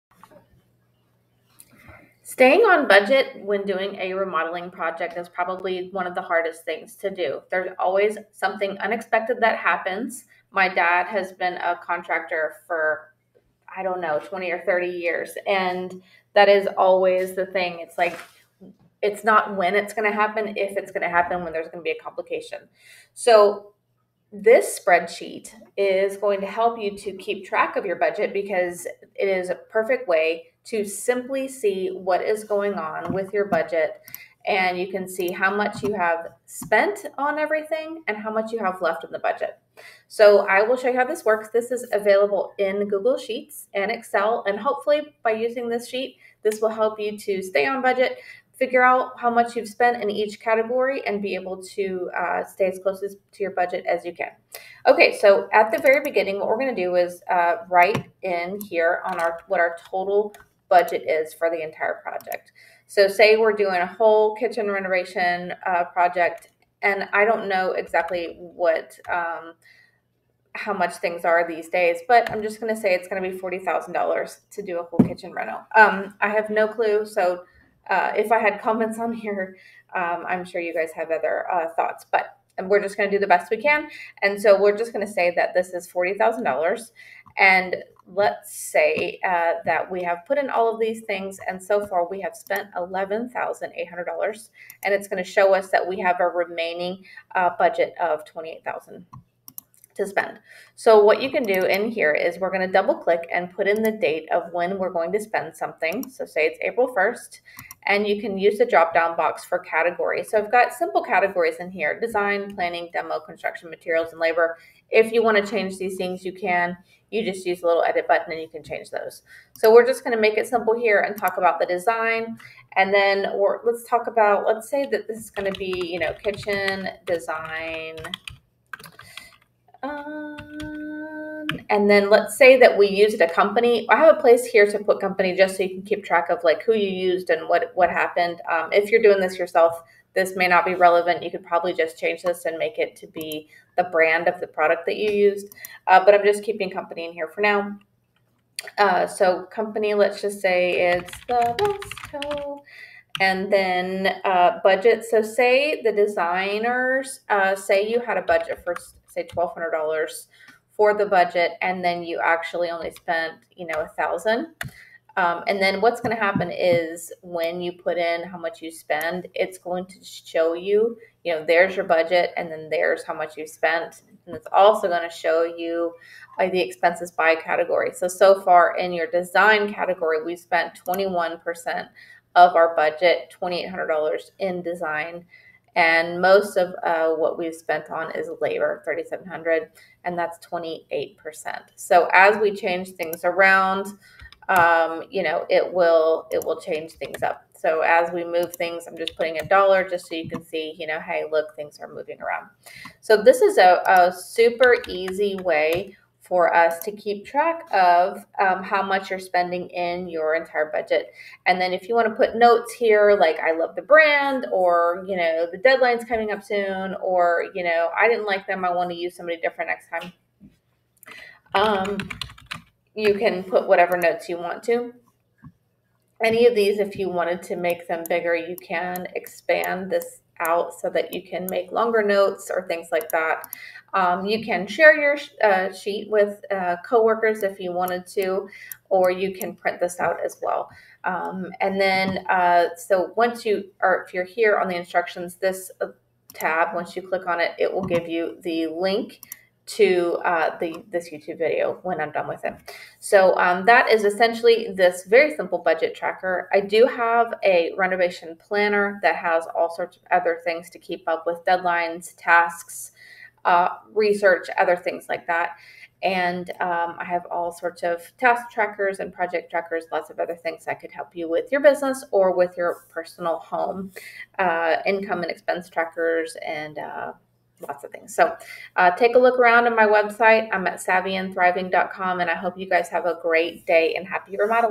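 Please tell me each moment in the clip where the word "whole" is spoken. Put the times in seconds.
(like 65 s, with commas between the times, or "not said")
63 s, 74 s.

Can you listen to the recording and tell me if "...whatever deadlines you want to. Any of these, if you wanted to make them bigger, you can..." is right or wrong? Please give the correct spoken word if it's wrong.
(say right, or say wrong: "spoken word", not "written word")
wrong: "notes", not "deadlines".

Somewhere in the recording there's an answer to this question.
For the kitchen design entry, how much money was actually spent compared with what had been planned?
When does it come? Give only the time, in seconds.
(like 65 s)
163 s.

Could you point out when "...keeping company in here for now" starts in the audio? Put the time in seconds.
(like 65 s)
146 s.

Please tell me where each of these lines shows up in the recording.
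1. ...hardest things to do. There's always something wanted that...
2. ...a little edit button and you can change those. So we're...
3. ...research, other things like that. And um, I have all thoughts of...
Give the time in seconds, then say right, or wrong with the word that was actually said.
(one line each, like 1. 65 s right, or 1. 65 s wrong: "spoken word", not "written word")
1. 6 s wrong: "unexpected", not "wanted"
2. 117 s right
3. 263 s wrong: "sorts", not "thoughts".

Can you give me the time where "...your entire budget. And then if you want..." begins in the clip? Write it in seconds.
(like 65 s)
210 s.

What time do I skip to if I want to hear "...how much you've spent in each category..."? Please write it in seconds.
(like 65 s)
49 s.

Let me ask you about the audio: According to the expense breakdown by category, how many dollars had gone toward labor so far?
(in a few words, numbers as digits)
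3,700.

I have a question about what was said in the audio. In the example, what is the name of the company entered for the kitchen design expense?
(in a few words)
Vesco.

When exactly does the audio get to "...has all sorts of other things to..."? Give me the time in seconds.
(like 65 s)
259 s.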